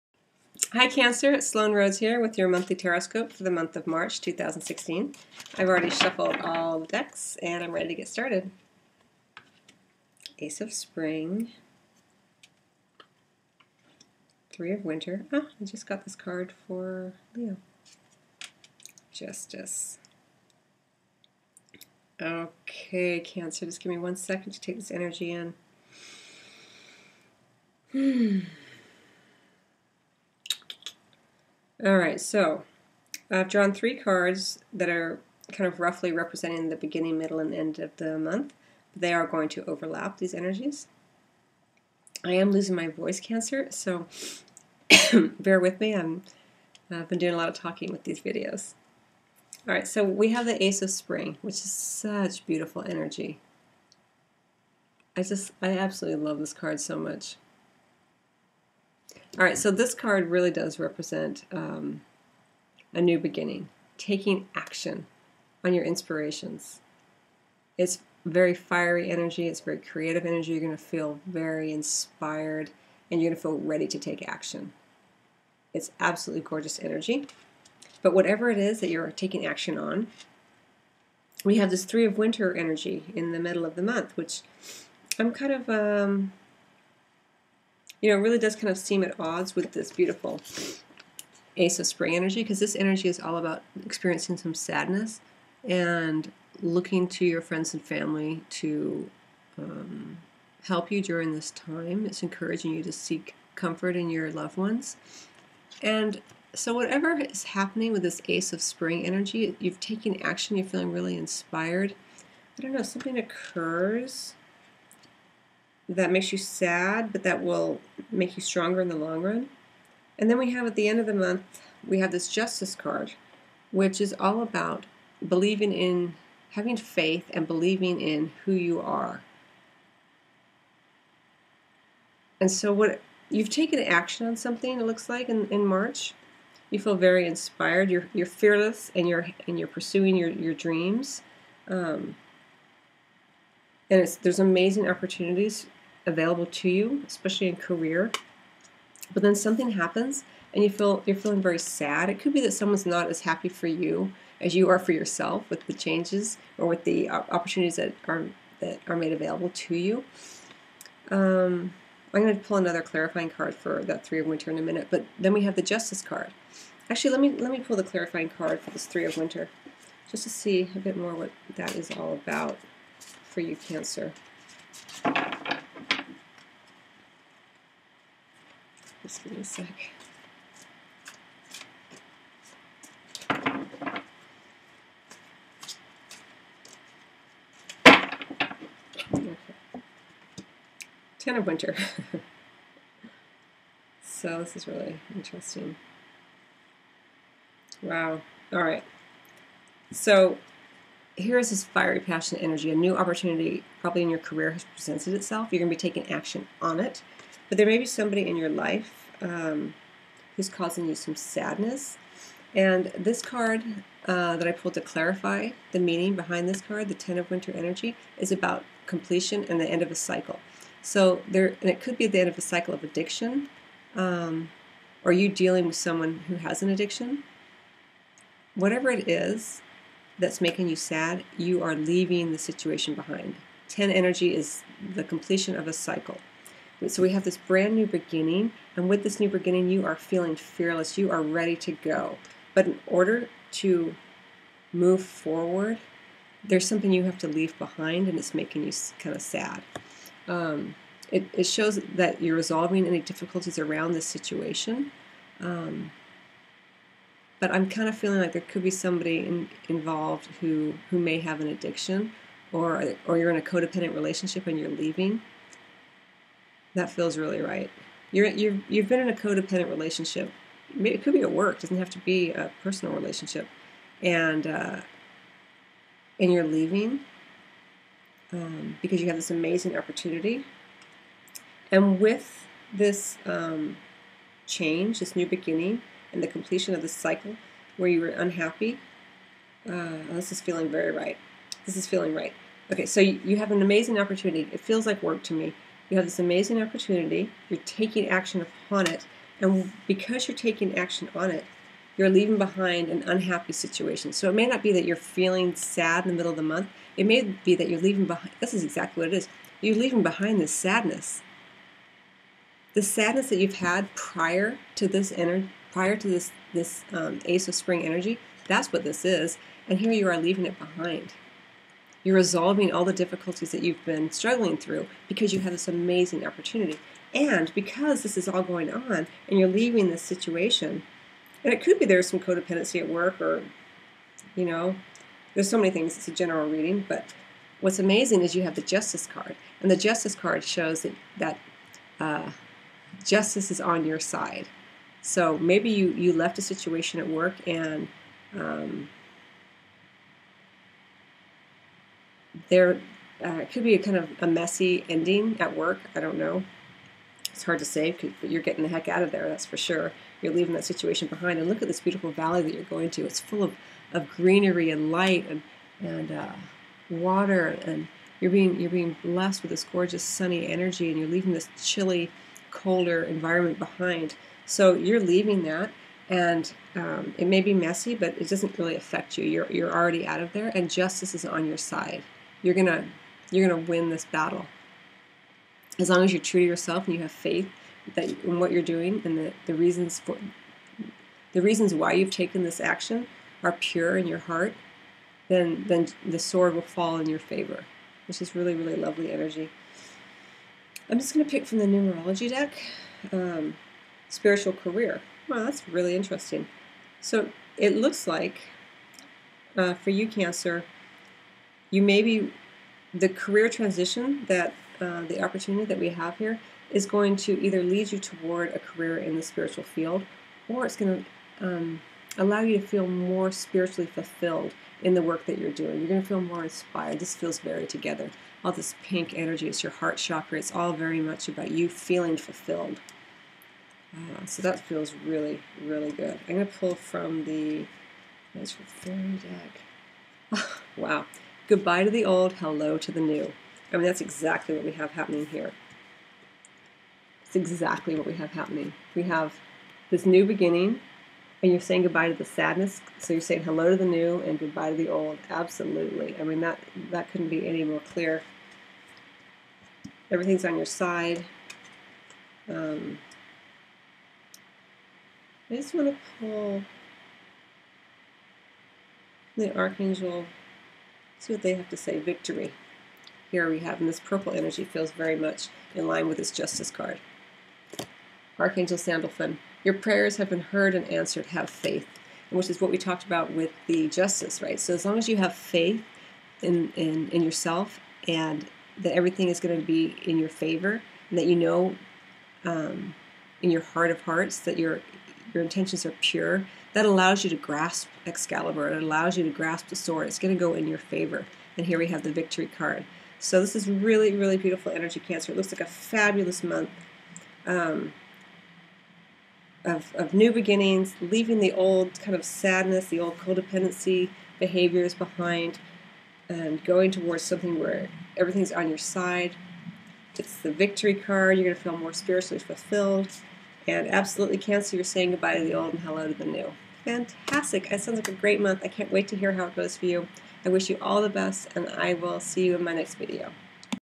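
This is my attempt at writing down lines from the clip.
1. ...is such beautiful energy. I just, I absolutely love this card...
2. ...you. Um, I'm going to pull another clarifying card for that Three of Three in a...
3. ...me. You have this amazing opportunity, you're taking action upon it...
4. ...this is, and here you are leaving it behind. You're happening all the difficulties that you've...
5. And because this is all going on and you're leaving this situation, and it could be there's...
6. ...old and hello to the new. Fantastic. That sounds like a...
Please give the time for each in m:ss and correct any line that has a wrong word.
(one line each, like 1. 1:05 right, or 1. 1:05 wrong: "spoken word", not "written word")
1. 0:51 right
2. 2:39 wrong: "Winter", not "Three"
3. 4:55 right
4. 5:18 wrong: "resolving", not "happening"
5. 5:27 right
6. 8:45 right.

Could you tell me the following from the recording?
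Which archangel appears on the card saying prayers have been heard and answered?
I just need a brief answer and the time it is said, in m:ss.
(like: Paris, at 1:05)
Sandalphon, at 7:58.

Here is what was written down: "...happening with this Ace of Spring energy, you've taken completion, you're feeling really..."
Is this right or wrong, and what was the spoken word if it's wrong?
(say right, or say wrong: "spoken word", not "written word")
wrong: "action", not "completion".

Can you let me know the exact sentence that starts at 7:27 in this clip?
It's exactly what we have happening.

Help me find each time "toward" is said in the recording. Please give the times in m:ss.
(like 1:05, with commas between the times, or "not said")
6:57, 8:36.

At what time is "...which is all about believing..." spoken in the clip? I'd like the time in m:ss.
2:03.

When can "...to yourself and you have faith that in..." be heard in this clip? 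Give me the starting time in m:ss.
6:26.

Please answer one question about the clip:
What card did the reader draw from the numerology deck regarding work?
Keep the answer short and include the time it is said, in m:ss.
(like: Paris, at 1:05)
spiritual career, at 6:44.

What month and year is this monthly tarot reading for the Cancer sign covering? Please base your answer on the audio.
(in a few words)
March 2016.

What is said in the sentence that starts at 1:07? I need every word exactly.
It's very fiery energy, it's very creative energy.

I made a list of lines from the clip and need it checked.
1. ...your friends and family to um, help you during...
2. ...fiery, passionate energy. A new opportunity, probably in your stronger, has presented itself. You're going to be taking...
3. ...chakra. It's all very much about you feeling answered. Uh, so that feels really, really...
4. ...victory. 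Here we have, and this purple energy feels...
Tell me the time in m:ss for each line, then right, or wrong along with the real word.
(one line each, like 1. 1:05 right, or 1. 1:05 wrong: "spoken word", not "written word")
1. 1:37 right
2. 3:21 wrong: "career", not "stronger"
3. 7:09 wrong: "fulfilled", not "answered"
4. 7:51 right.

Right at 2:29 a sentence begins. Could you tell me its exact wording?
But then something happens and you feel you're feeling very sad.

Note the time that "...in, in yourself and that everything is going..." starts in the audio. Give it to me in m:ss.
8:06.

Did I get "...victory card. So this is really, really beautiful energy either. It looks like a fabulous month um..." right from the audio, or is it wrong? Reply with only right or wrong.
wrong.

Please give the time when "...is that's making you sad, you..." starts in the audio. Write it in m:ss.
3:49.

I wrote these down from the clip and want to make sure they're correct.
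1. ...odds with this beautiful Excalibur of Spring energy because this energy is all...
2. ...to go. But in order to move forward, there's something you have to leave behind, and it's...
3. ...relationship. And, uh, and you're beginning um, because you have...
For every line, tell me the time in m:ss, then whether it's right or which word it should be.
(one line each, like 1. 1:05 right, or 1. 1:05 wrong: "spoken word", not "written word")
1. 1:29 wrong: "Ace", not "Excalibur"
2. 4:01 right
3. 4:32 wrong: "leaving", not "beginning".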